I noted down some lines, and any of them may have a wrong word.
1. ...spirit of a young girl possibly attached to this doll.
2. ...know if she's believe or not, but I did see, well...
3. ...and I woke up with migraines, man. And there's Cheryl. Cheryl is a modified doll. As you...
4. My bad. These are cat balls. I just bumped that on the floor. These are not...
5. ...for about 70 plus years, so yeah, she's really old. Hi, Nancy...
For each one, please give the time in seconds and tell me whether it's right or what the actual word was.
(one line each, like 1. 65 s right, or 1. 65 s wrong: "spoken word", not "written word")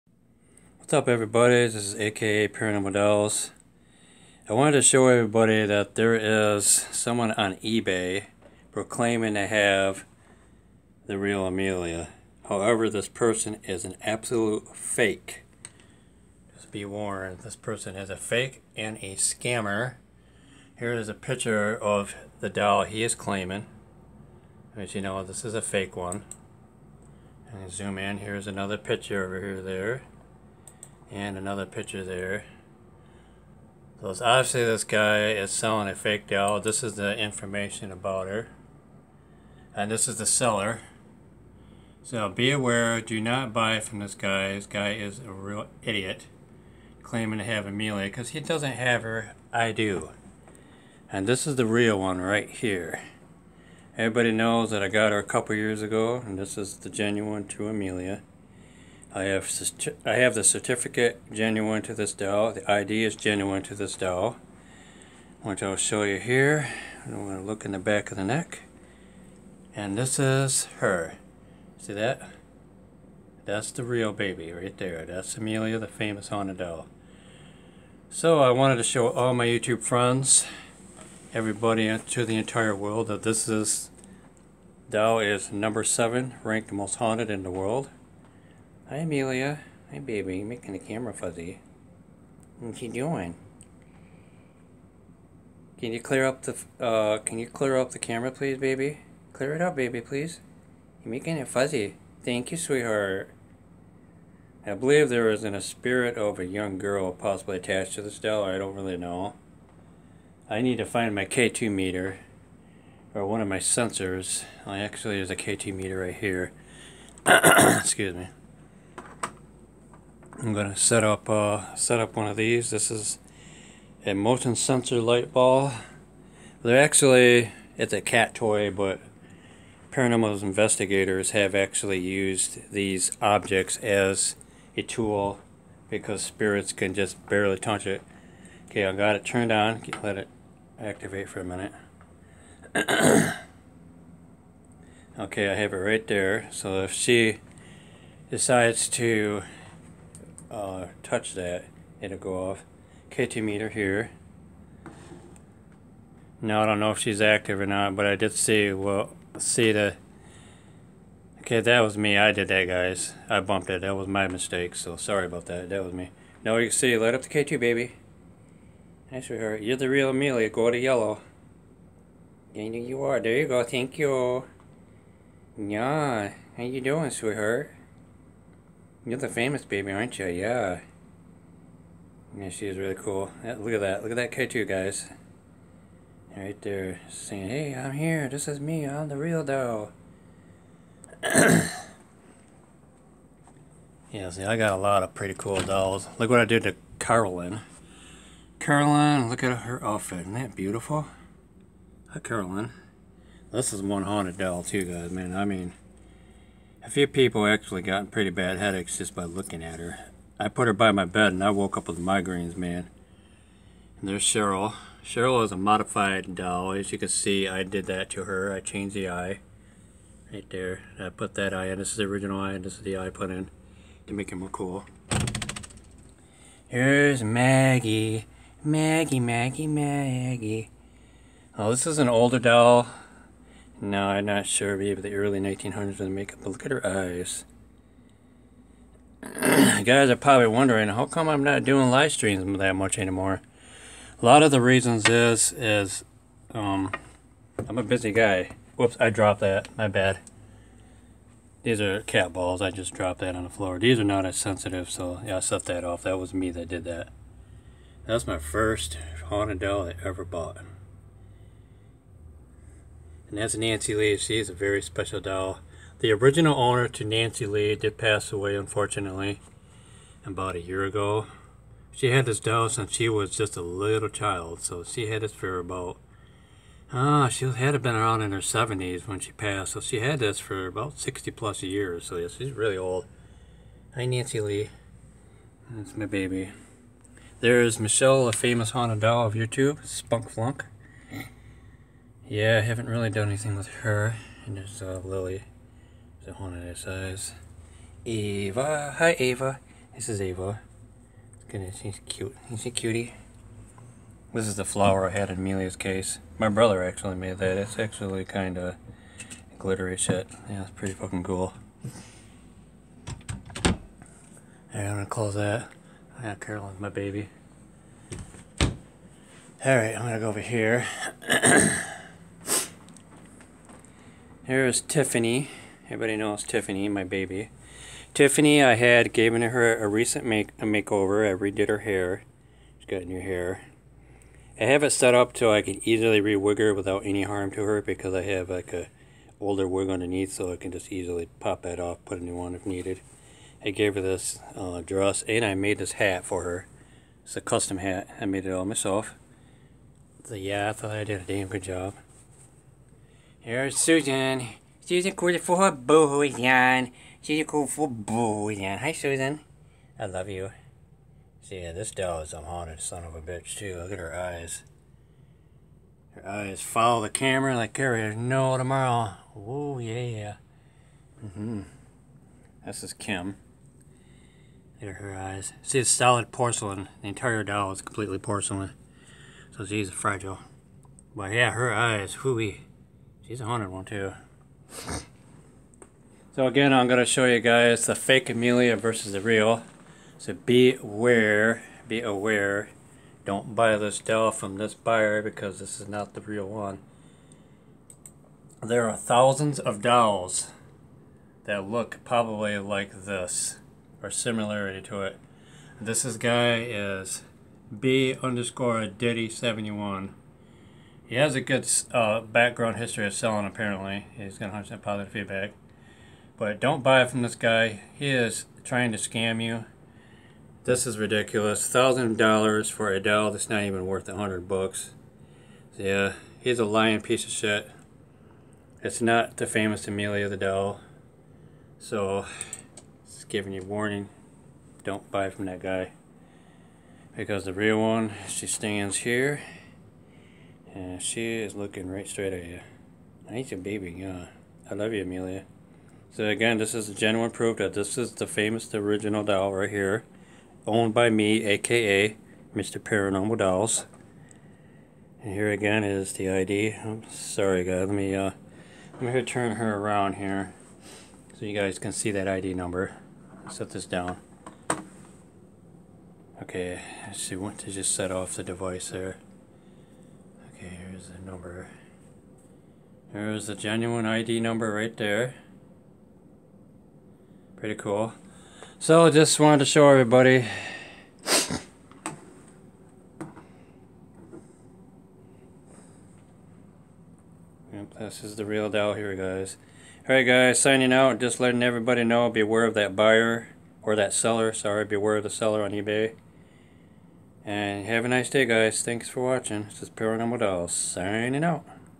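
1. 105 s right
2. 156 s wrong: "active", not "believe"
3. 211 s right
4. 249 s wrong: "dropped", not "bumped"
5. 280 s wrong: "60", not "70".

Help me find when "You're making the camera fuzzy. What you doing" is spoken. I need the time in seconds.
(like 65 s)
90 s.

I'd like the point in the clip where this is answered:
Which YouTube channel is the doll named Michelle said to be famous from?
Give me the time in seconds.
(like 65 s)
289 s.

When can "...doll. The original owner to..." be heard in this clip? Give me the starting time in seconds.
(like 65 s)
265 s.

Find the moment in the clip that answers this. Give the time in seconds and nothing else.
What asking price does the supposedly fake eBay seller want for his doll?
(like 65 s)
421 s.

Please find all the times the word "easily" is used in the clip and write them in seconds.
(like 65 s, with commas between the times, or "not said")
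335 s, 340 s.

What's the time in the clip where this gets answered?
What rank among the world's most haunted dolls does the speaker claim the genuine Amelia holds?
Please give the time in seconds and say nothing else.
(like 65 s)
85 s.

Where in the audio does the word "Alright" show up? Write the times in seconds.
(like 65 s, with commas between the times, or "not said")
314 s, 319 s, 490 s.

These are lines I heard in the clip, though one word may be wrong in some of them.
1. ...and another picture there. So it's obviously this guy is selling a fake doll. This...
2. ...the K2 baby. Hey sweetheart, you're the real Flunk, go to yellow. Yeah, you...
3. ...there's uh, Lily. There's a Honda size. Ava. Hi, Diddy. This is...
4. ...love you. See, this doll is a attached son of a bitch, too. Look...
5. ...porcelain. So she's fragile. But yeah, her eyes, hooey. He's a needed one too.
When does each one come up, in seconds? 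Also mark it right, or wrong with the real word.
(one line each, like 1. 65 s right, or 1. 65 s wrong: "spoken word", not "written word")
1. 31 s right
2. 167 s wrong: "Amelia", not "Flunk"
3. 294 s wrong: "Ava", not "Diddy"
4. 360 s wrong: "haunted", not "attached"
5. 378 s wrong: "haunted", not "needed".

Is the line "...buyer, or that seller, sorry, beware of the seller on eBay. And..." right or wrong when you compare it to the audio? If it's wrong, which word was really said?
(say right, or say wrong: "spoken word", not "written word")
right.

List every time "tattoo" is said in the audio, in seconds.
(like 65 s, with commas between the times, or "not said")
184 s.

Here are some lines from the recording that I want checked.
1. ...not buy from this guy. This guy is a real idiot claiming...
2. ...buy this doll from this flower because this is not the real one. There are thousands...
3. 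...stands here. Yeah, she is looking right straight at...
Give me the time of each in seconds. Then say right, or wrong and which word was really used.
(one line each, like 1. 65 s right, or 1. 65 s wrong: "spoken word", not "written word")
1. 43 s right
2. 393 s wrong: "buyer", not "flower"
3. 438 s right.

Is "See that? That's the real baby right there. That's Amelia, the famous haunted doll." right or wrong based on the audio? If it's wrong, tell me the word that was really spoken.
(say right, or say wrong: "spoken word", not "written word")
right.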